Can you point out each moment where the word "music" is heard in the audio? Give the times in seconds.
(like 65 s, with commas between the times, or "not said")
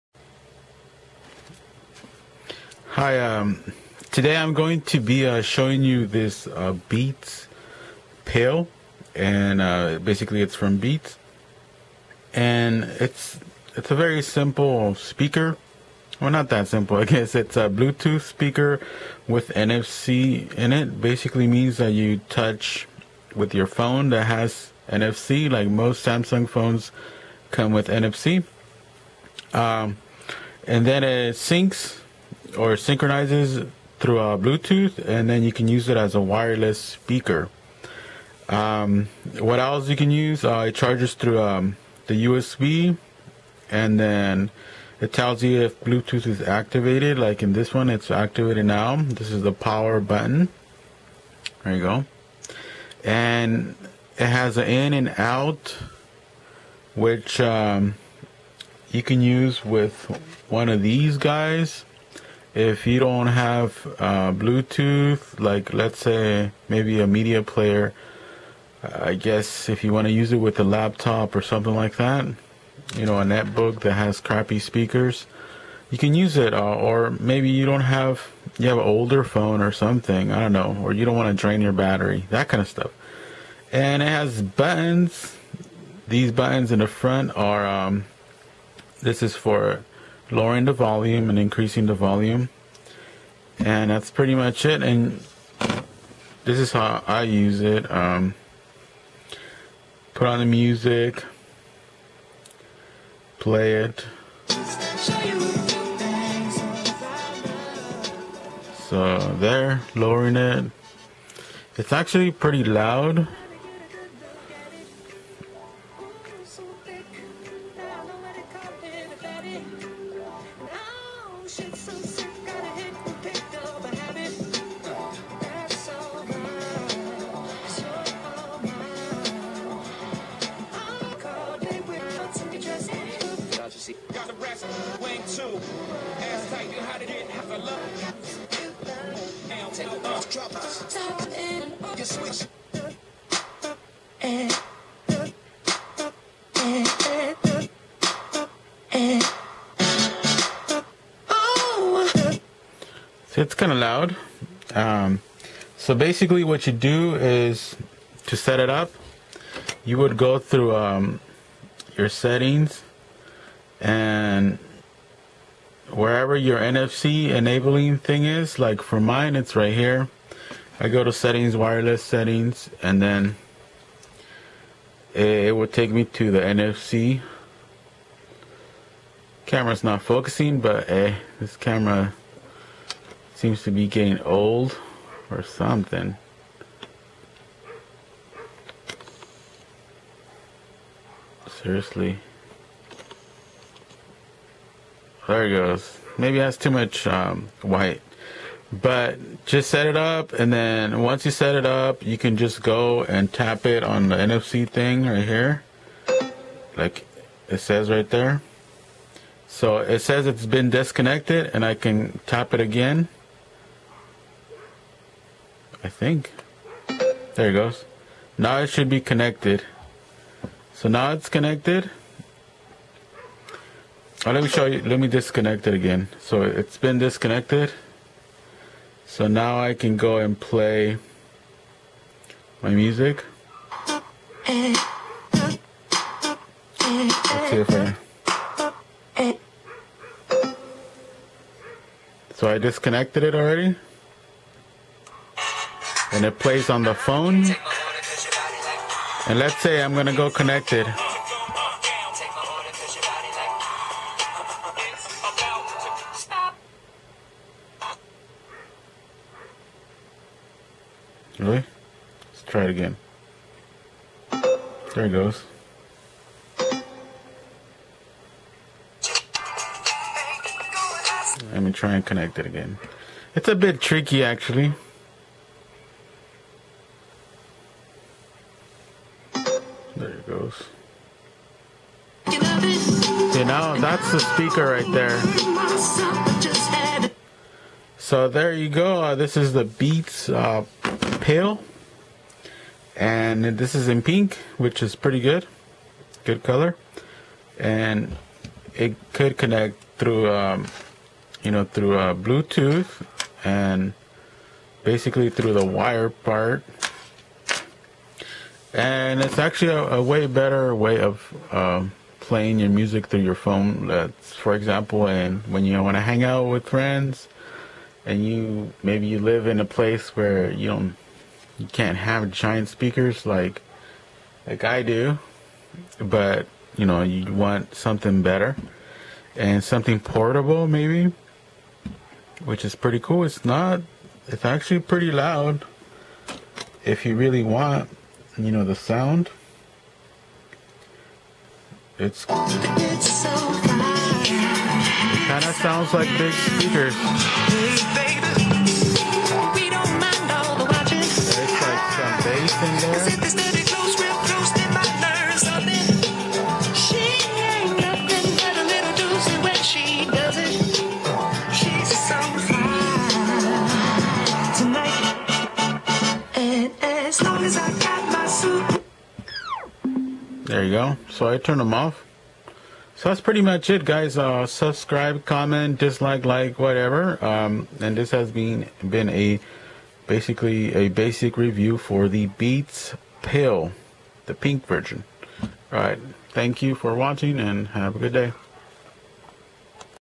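100 s, 232 s, 312 s.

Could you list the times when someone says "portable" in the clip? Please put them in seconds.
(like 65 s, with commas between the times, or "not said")
329 s.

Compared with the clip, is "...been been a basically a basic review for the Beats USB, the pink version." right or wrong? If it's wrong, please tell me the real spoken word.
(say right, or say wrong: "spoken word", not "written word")
wrong: "Pill", not "USB".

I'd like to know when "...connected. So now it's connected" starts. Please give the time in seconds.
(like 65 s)
219 s.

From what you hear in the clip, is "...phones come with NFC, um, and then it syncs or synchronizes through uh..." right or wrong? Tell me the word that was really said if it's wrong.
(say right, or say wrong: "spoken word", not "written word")
right.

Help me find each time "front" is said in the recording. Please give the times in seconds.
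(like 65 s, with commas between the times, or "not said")
86 s.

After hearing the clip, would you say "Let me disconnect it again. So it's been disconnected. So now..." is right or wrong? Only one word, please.
right.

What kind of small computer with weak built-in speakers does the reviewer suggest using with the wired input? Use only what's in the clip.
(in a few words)
netbook.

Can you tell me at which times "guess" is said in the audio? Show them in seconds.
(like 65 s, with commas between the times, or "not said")
17 s, 69 s.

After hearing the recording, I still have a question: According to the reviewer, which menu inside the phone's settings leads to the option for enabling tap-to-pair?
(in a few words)
wireless settings.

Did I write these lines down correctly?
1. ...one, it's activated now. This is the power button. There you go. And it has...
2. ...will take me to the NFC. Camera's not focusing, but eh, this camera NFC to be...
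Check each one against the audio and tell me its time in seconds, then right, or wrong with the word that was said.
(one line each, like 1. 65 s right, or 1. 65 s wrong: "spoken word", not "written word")
1. 47 s right
2. 175 s wrong: "Seems", not "NFC".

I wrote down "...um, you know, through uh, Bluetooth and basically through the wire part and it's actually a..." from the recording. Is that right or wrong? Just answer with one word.
right.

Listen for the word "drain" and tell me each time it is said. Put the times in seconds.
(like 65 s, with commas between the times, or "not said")
81 s.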